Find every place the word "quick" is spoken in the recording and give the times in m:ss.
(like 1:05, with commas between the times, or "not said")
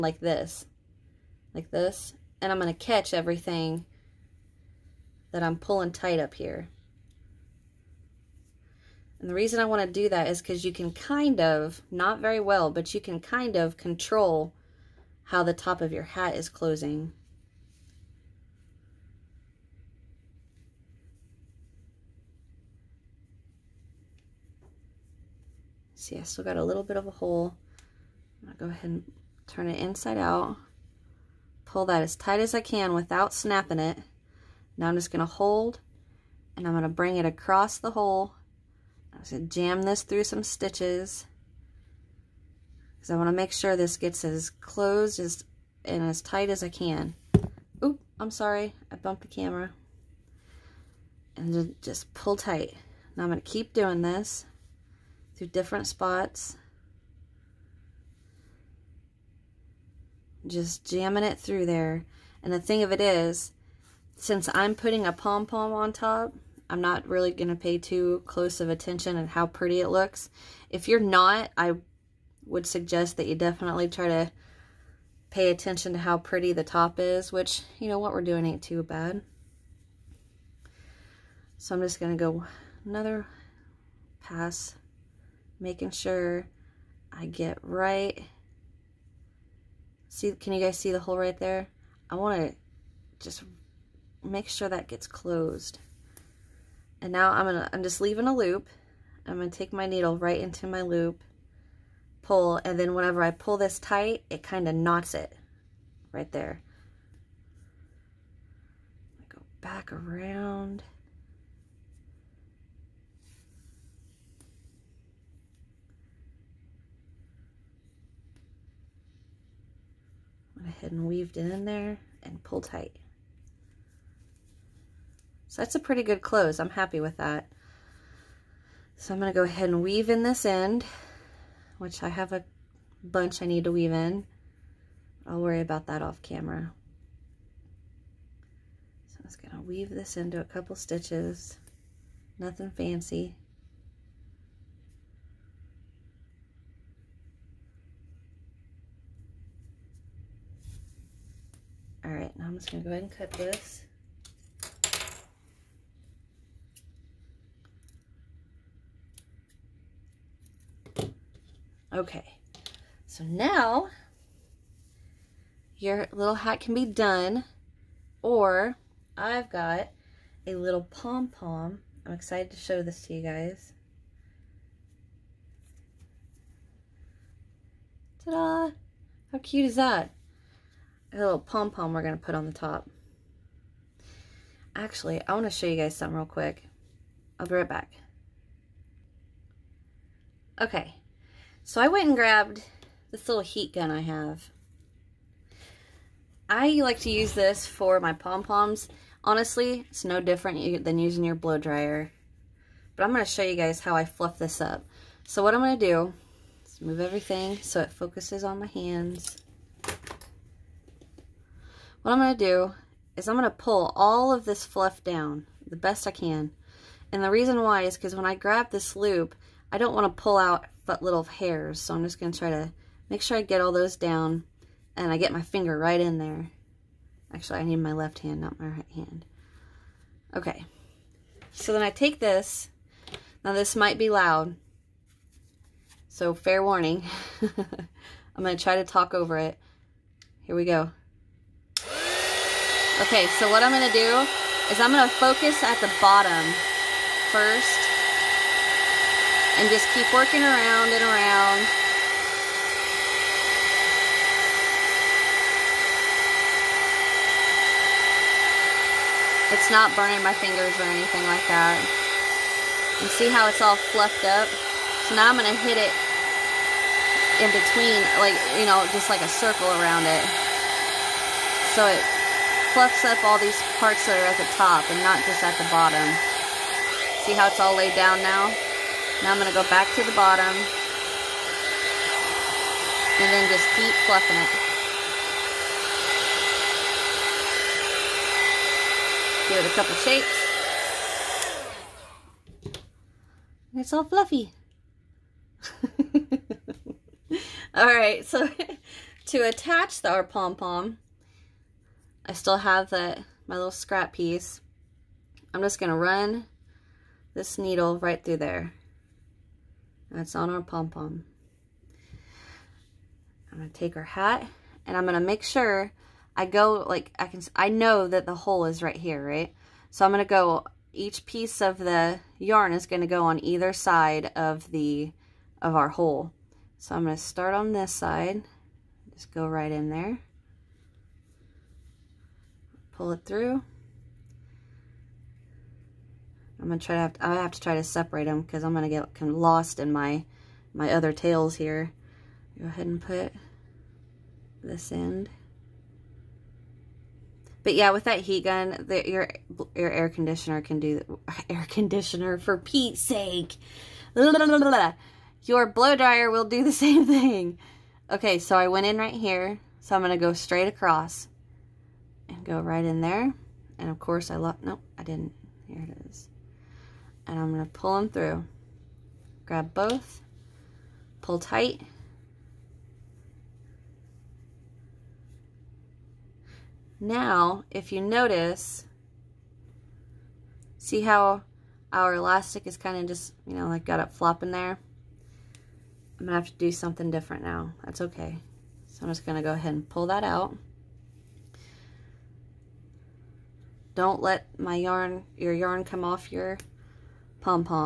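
3:06.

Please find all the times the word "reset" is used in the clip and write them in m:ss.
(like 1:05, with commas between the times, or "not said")
not said.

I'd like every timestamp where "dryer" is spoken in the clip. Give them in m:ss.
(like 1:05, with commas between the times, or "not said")
3:21, 5:55.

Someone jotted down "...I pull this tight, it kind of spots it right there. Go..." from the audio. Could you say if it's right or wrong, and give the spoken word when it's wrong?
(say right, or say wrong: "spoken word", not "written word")
wrong: "knots", not "spots".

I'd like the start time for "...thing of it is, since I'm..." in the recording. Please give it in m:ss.
1:02.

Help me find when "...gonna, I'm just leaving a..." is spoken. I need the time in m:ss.
1:37.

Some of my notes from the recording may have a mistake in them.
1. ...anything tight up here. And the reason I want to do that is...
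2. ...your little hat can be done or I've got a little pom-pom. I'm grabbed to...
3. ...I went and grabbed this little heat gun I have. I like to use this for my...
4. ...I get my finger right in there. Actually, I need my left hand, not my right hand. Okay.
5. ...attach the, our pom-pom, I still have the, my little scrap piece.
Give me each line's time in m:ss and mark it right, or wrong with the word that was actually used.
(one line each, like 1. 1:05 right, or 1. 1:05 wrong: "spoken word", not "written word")
1. 0:05 wrong: "pulling", not "anything"
2. 2:45 wrong: "excited", not "grabbed"
3. 3:11 right
4. 3:45 right
5. 4:59 right.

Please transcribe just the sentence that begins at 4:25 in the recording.
So now I'm going to hit it in between, like, you know, just like a circle around it.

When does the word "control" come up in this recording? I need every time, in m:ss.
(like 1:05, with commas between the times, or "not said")
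0:13.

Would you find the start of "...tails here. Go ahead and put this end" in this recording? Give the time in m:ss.
5:41.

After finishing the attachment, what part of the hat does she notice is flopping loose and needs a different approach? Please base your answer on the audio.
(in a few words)
elastic.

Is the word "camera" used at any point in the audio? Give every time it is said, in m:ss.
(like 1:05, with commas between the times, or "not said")
0:49, 2:16.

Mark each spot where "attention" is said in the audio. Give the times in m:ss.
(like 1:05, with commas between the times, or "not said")
1:08, 1:15.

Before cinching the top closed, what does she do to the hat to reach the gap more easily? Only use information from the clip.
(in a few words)
turn it inside out.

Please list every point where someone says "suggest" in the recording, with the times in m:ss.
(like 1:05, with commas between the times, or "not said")
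1:12.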